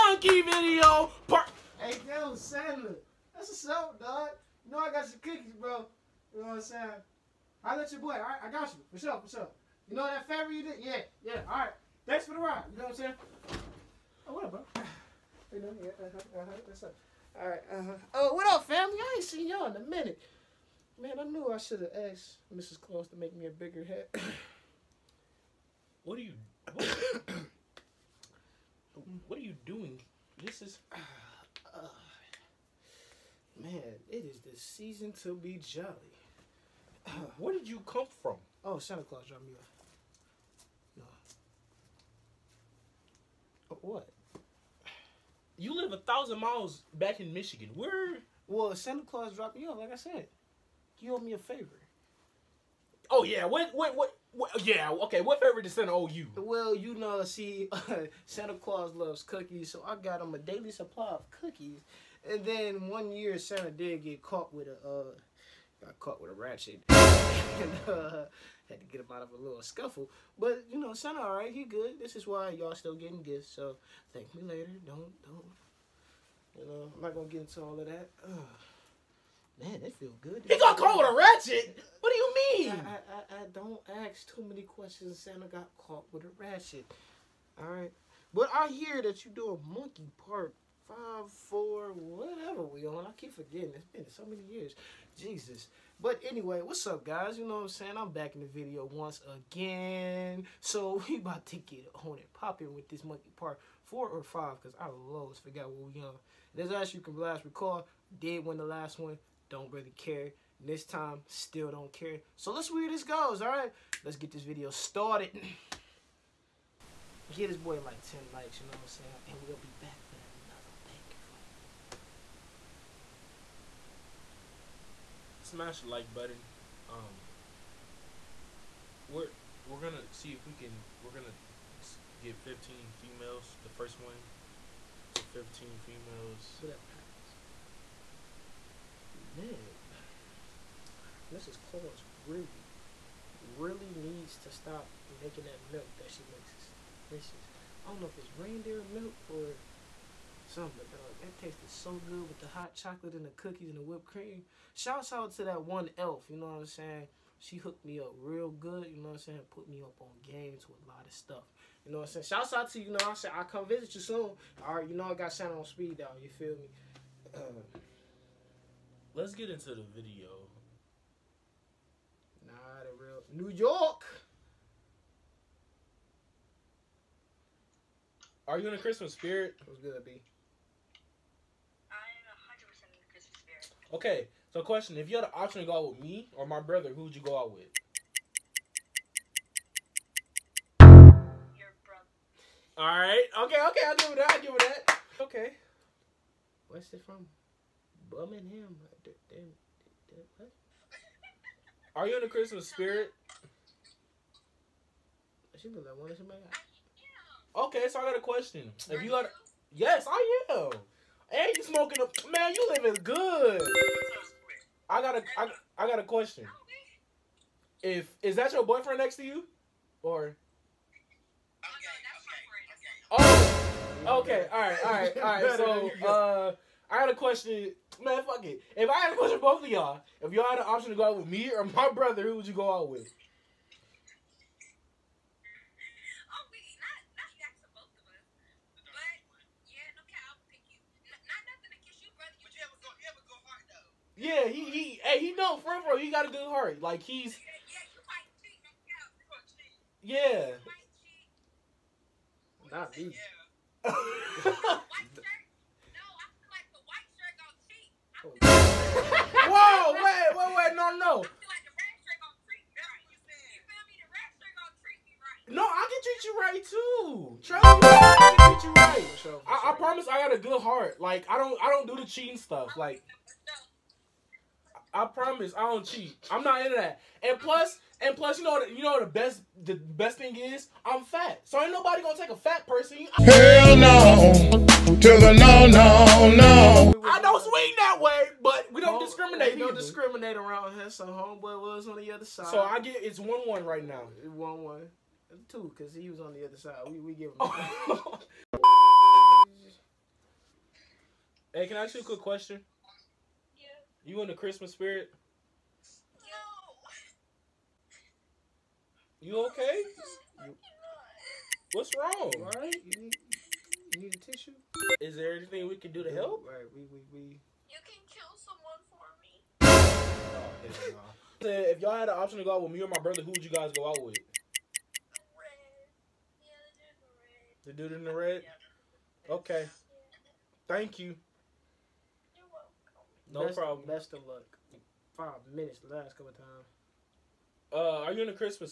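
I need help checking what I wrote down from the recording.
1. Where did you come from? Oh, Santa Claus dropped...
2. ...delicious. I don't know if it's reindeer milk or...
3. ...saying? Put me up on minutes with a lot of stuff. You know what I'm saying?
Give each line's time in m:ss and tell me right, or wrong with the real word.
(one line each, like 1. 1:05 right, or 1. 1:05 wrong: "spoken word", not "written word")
1. 0:37 right
2. 2:27 right
3. 2:39 wrong: "games", not "minutes".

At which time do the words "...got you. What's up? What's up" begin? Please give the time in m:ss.
0:08.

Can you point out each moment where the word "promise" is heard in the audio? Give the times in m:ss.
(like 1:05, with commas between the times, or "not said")
4:35.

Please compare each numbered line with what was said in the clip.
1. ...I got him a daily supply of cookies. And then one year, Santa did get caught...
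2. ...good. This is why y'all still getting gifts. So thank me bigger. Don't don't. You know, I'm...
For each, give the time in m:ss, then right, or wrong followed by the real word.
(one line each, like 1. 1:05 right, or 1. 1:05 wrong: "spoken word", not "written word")
1. 0:59 right
2. 1:11 wrong: "later", not "bigger".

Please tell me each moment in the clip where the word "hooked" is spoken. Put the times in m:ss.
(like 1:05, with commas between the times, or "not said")
2:37.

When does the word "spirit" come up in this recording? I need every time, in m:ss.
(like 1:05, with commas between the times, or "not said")
2:59, 3:22, 5:04.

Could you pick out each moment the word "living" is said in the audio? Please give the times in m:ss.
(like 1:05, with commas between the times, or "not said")
3:32.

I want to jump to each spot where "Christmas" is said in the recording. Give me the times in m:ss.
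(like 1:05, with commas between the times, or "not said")
2:58, 3:22, 5:04.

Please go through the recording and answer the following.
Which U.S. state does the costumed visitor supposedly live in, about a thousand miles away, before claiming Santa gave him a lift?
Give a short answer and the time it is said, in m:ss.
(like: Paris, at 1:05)
Michigan, at 0:47.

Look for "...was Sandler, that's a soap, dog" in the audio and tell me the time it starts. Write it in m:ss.
0:02.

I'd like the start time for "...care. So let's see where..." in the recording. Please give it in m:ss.
1:51.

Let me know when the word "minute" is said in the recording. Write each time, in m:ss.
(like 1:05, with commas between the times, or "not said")
0:19, 5:35.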